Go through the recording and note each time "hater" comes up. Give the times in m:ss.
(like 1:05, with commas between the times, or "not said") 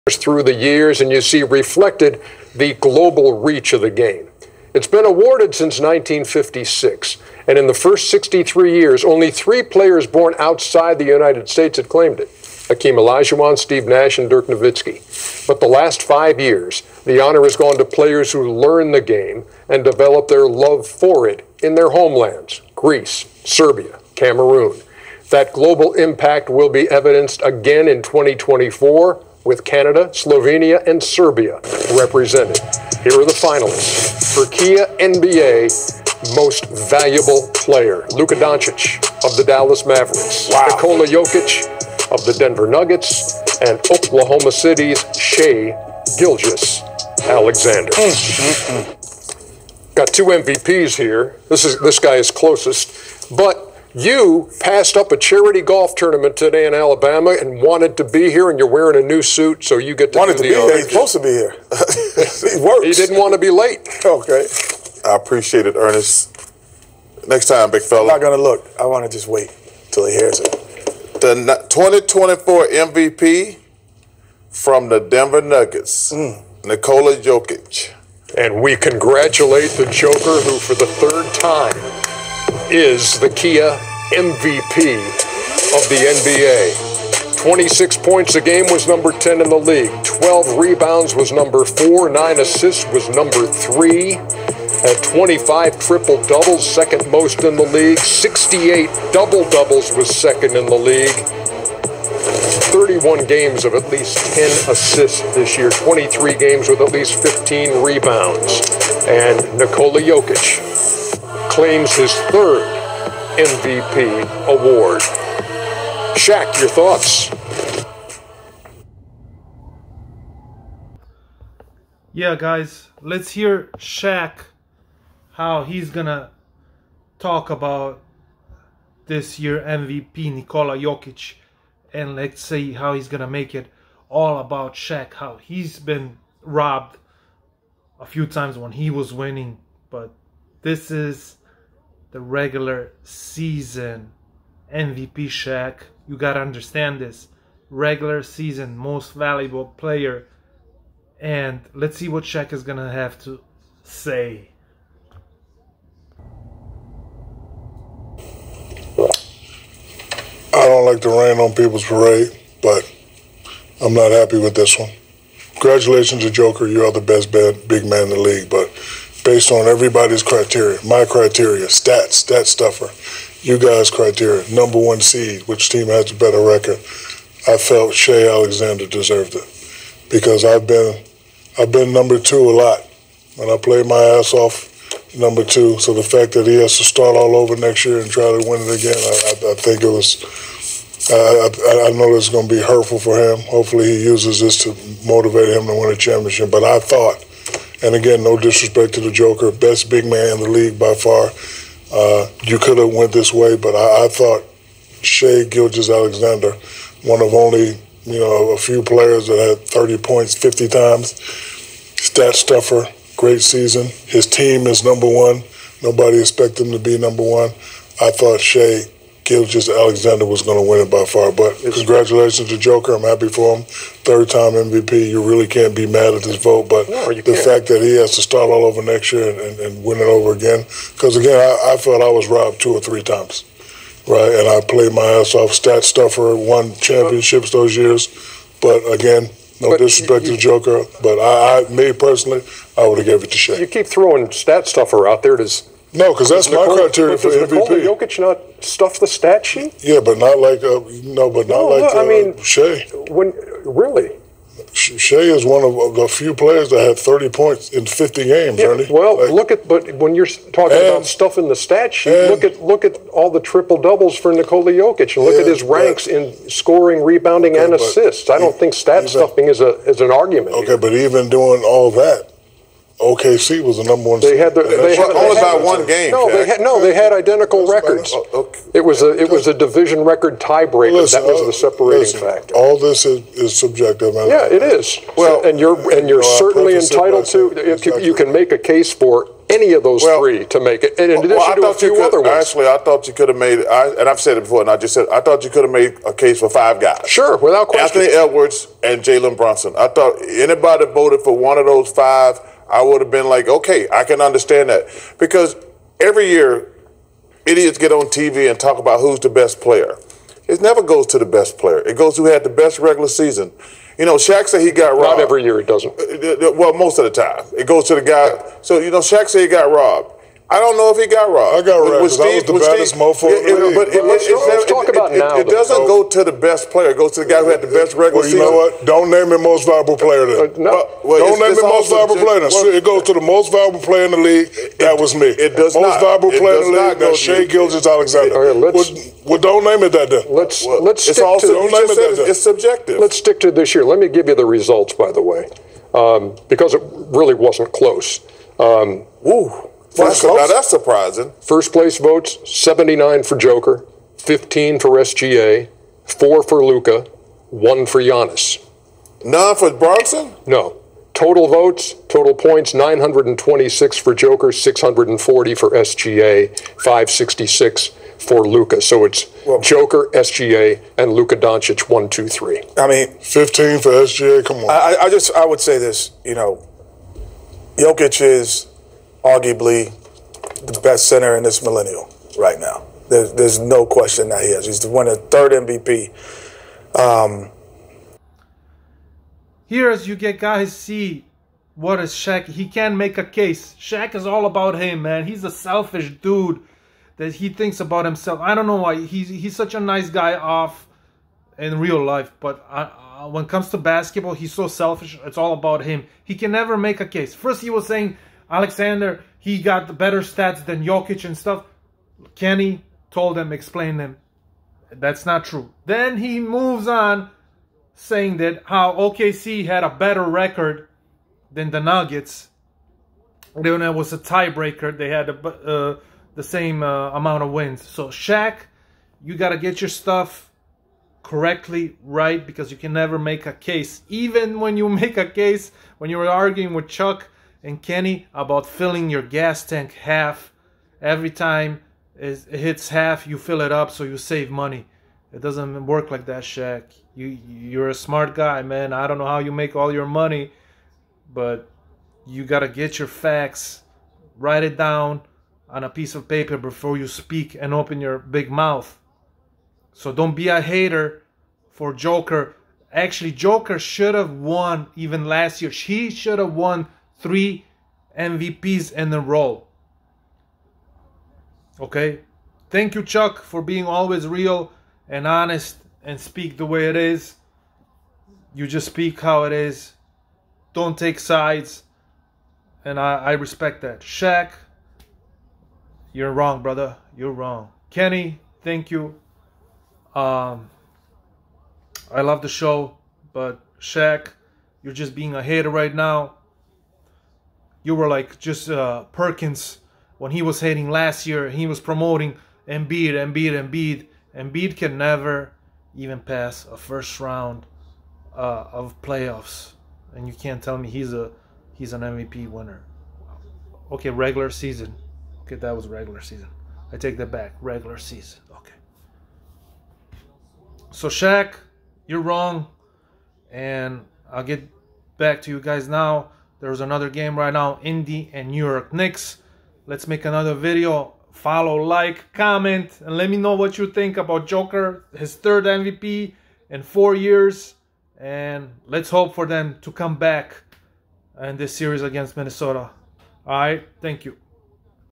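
7:40, 8:15.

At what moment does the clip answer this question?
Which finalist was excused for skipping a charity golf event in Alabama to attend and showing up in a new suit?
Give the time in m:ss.
1:05.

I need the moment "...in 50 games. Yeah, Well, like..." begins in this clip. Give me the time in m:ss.
4:17.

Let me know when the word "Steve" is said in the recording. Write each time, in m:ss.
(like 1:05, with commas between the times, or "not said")
0:13, 5:22.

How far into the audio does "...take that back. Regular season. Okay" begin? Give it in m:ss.
8:36.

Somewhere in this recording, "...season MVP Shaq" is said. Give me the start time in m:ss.
2:23.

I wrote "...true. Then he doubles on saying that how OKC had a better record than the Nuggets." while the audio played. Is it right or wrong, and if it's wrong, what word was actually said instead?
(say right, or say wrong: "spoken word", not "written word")
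wrong: "moves", not "doubles".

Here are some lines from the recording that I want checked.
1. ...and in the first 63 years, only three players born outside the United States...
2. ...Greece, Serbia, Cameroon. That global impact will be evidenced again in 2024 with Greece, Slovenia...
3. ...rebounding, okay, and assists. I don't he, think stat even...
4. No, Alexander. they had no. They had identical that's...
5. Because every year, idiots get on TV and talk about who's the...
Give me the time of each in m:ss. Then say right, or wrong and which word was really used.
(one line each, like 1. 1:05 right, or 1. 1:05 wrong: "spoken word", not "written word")
1. 0:07 right
2. 0:22 wrong: "Canada", not "Greece"
3. 4:27 right
4. 4:36 wrong: "Jack", not "Alexander"
5. 5:05 right.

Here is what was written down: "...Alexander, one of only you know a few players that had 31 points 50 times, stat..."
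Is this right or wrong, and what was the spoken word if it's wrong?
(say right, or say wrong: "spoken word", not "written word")
wrong: "30", not "31".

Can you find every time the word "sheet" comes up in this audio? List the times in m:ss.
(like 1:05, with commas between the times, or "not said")
4:09, 4:21.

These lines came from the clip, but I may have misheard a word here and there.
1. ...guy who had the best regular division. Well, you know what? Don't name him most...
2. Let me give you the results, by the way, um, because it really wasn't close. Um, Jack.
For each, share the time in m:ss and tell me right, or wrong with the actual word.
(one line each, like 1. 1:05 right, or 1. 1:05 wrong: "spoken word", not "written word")
1. 5:27 wrong: "season", not "division"
2. 5:43 wrong: "Ooh", not "Jack".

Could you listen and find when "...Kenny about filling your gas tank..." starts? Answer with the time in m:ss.
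7:17.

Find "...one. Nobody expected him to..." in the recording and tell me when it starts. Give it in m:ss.
3:35.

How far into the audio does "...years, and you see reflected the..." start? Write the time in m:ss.
0:00.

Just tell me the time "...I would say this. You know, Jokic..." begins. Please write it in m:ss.
6:15.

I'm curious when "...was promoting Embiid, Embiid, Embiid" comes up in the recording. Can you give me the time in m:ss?
8:21.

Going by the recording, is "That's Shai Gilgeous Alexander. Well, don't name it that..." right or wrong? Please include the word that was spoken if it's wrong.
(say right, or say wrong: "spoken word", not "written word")
right.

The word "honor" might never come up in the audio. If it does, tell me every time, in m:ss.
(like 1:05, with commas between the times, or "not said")
0:17.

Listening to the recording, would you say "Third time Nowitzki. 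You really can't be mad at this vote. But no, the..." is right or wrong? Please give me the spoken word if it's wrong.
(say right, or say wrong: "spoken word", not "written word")
wrong: "MVP", not "Nowitzki".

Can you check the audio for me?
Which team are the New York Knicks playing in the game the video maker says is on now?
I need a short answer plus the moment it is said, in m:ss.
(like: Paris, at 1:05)
Indy, at 8:47.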